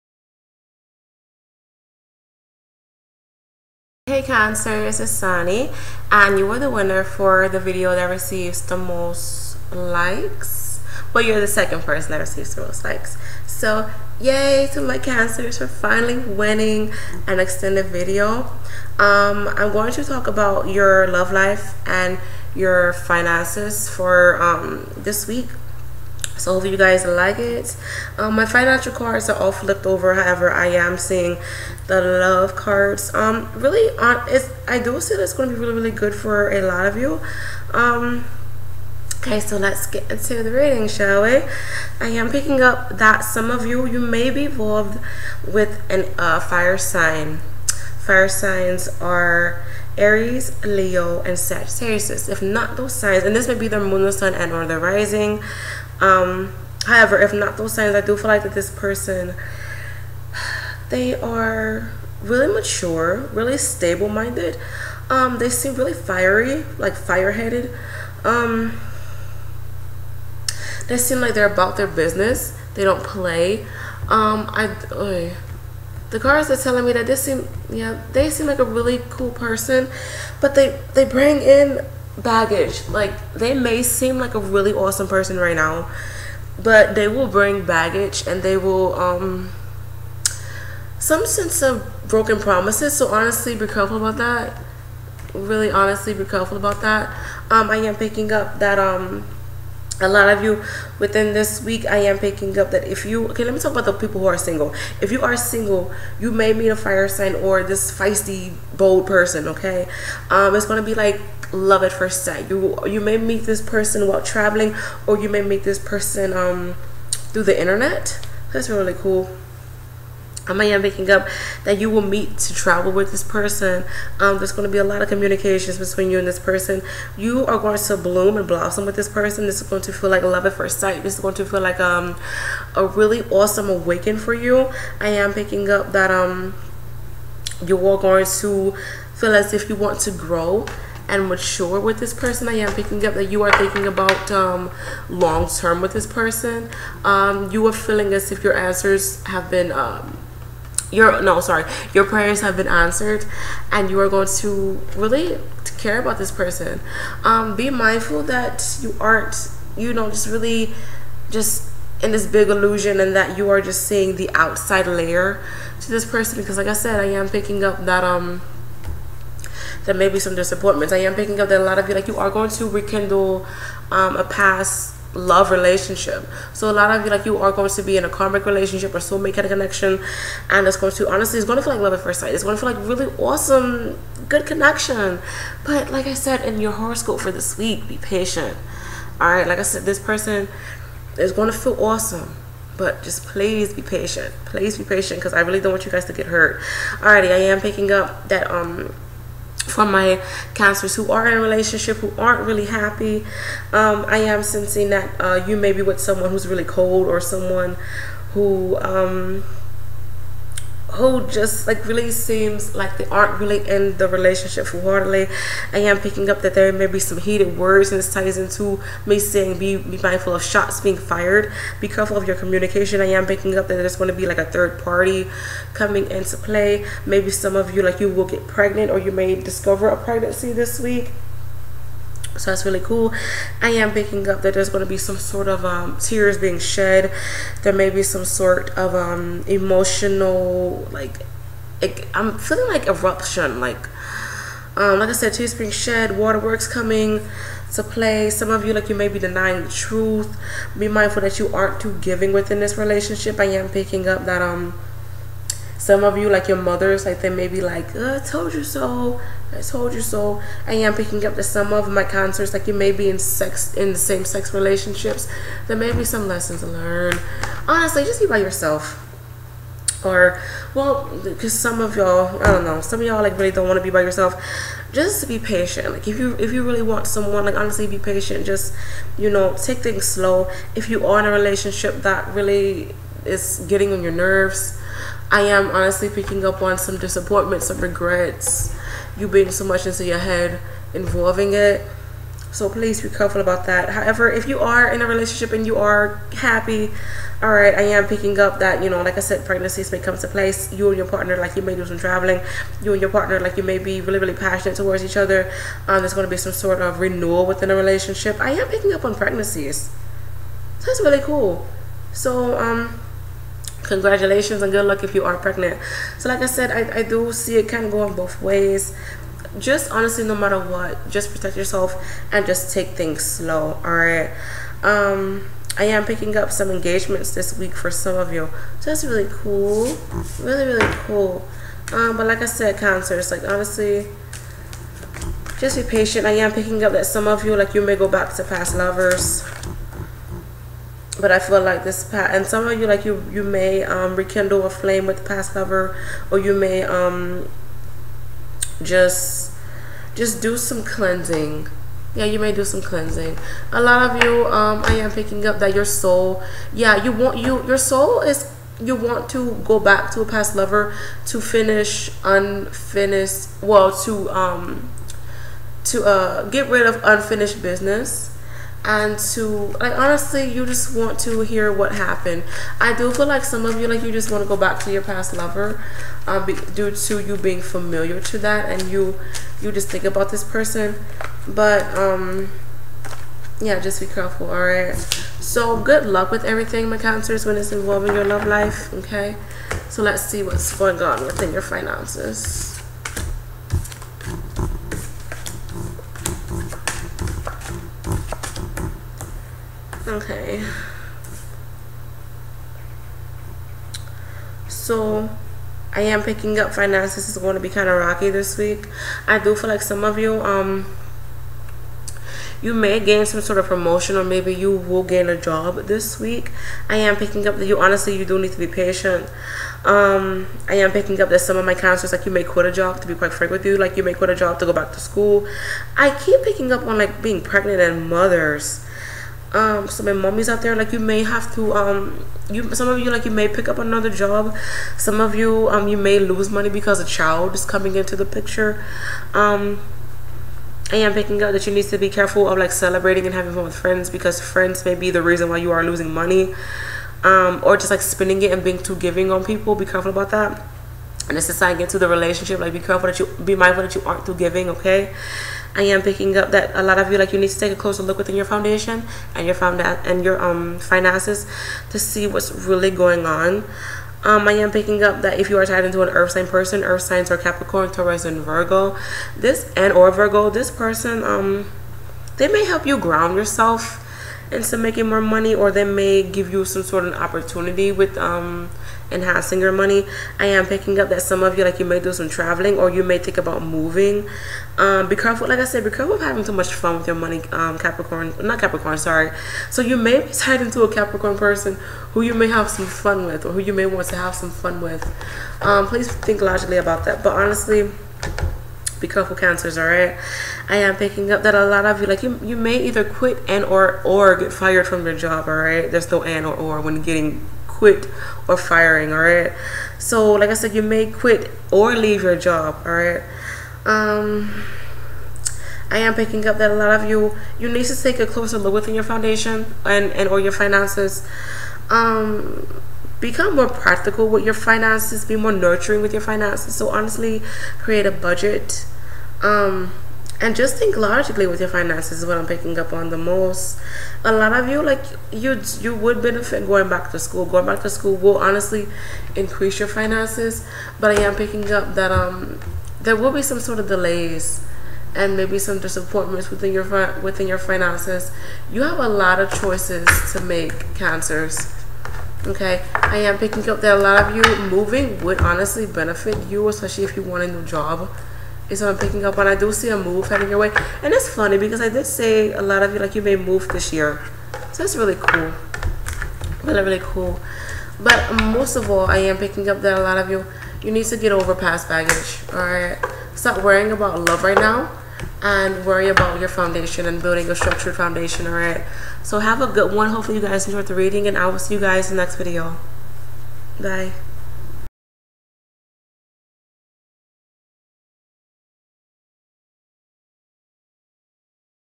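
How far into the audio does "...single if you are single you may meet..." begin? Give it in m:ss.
1:44.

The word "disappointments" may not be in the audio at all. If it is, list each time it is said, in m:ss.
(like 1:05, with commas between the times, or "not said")
2:50, 4:46, 9:05.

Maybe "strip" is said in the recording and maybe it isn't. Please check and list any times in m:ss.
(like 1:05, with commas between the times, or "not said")
not said.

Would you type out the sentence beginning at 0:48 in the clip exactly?
Fire signs are Aries, Leo, and Sagittarius.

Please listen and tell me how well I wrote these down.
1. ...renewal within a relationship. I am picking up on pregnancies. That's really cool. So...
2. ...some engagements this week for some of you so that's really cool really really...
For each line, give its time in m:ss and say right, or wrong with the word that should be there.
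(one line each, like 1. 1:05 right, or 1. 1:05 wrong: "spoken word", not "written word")
1. 5:06 right
2. 5:26 right.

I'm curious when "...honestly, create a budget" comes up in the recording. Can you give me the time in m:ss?
8:46.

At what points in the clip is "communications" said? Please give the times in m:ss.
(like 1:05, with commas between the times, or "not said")
2:05, 3:42.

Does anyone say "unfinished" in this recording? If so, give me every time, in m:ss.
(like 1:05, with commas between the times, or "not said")
6:02, 6:07.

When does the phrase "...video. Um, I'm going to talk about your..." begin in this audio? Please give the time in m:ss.
0:17.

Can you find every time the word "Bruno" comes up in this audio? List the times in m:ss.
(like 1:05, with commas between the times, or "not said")
not said.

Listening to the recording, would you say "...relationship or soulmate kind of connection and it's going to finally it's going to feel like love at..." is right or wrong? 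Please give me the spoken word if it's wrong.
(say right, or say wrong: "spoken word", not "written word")
wrong: "honestly", not "finally".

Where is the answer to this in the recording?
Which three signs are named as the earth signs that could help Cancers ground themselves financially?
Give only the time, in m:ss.
7:47.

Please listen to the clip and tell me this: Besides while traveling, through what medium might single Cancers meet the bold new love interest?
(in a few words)
The internet.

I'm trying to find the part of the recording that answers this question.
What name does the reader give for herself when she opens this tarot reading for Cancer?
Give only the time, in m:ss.
0:05.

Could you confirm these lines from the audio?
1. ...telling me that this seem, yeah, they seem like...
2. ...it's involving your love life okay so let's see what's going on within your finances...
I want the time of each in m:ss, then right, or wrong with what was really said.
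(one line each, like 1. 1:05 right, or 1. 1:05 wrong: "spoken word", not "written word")
1. 1:16 right
2. 6:27 right.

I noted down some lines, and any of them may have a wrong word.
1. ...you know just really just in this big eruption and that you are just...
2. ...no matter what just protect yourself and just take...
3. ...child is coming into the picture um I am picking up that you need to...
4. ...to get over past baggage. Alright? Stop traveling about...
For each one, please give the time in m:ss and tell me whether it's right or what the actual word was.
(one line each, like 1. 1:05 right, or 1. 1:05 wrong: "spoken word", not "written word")
1. 2:39 wrong: "illusion", not "eruption"
2. 5:20 right
3. 7:17 right
4. 9:31 wrong: "worrying", not "traveling".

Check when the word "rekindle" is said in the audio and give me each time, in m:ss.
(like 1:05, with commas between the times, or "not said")
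2:52, 5:44.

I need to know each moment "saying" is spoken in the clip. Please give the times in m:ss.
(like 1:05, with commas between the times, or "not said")
3:39.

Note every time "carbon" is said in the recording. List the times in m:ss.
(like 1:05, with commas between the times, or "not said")
not said.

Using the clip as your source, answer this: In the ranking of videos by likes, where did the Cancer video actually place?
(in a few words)
Second.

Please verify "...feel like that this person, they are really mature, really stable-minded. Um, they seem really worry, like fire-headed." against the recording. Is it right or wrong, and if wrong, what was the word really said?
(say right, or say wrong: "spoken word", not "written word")
wrong: "fiery", not "worry".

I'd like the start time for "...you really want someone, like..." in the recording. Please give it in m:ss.
4:36.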